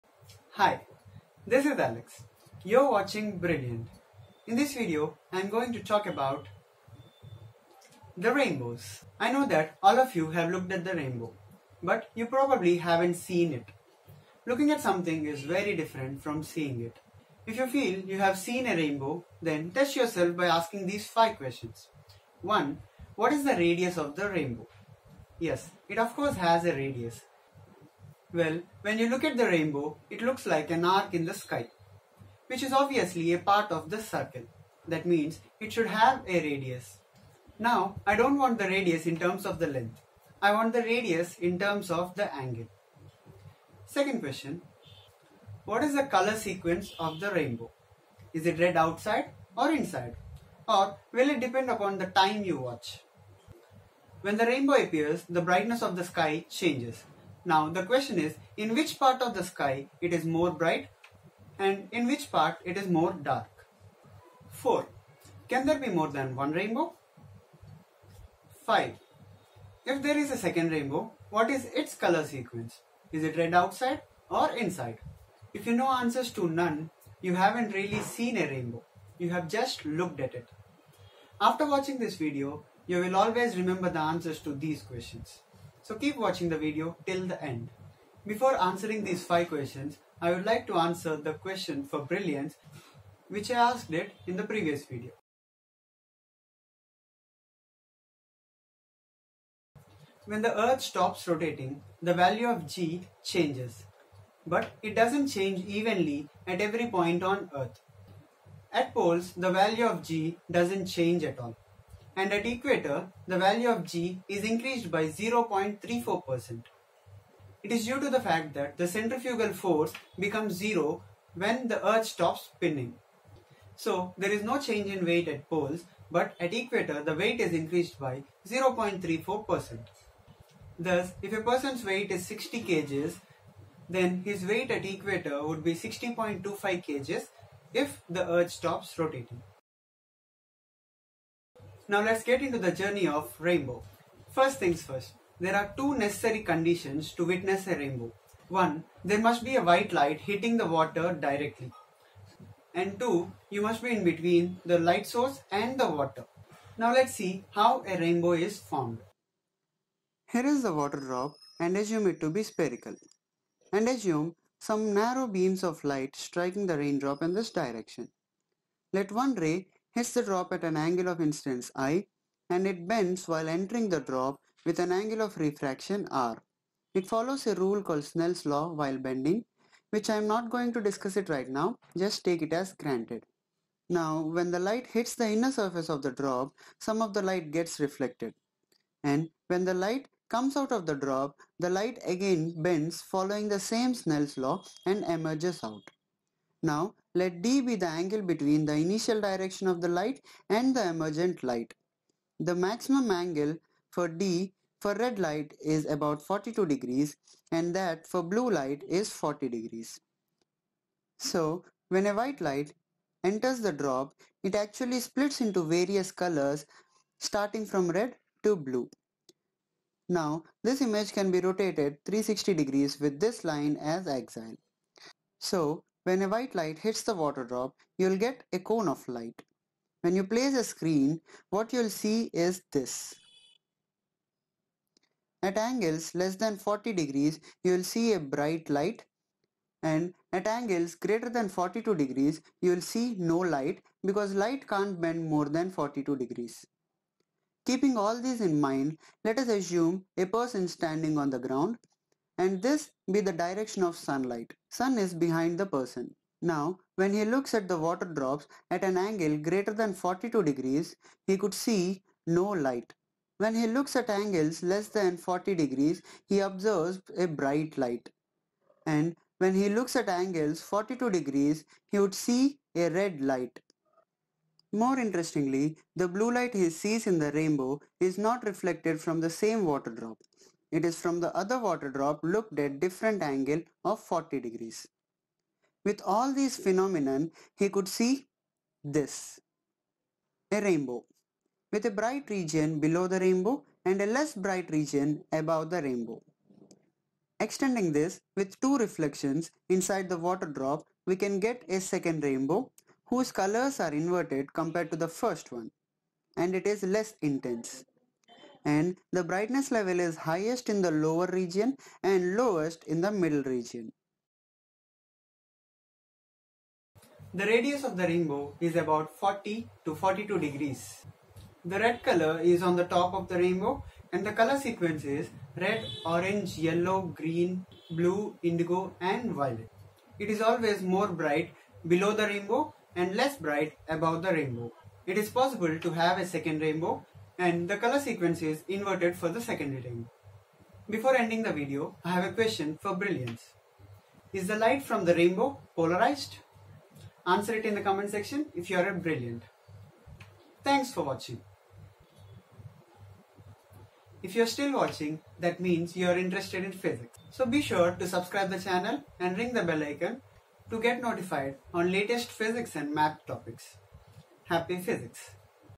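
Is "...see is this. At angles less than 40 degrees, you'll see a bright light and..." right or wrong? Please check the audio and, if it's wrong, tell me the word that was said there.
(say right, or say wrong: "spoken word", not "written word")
right.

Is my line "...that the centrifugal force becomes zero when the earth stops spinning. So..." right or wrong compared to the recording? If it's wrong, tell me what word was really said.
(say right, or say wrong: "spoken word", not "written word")
right.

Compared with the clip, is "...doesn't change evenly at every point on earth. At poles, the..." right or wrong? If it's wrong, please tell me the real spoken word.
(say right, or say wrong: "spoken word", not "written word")
right.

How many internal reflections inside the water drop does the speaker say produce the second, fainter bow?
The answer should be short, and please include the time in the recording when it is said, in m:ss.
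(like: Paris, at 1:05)
2, at 4:58.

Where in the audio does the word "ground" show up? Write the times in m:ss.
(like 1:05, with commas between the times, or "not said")
4:11.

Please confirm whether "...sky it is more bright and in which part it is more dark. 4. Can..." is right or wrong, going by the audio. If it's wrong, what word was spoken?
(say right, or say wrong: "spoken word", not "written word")
right.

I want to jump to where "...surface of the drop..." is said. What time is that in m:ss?
3:05.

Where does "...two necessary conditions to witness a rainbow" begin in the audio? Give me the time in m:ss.
2:25.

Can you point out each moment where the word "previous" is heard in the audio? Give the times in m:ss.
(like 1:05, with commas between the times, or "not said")
1:34.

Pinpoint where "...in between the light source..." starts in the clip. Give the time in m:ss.
2:33.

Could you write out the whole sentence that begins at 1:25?
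So keep watching the video till the end.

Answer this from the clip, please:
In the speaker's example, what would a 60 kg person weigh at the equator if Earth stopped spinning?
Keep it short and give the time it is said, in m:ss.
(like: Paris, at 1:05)
60.25 kg, at 2:15.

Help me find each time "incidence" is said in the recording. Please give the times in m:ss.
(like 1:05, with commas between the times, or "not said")
2:51.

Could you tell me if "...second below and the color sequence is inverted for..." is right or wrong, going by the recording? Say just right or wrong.
wrong.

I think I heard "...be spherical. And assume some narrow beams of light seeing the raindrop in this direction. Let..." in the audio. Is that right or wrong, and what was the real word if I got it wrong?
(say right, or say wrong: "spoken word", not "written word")
wrong: "striking", not "seeing".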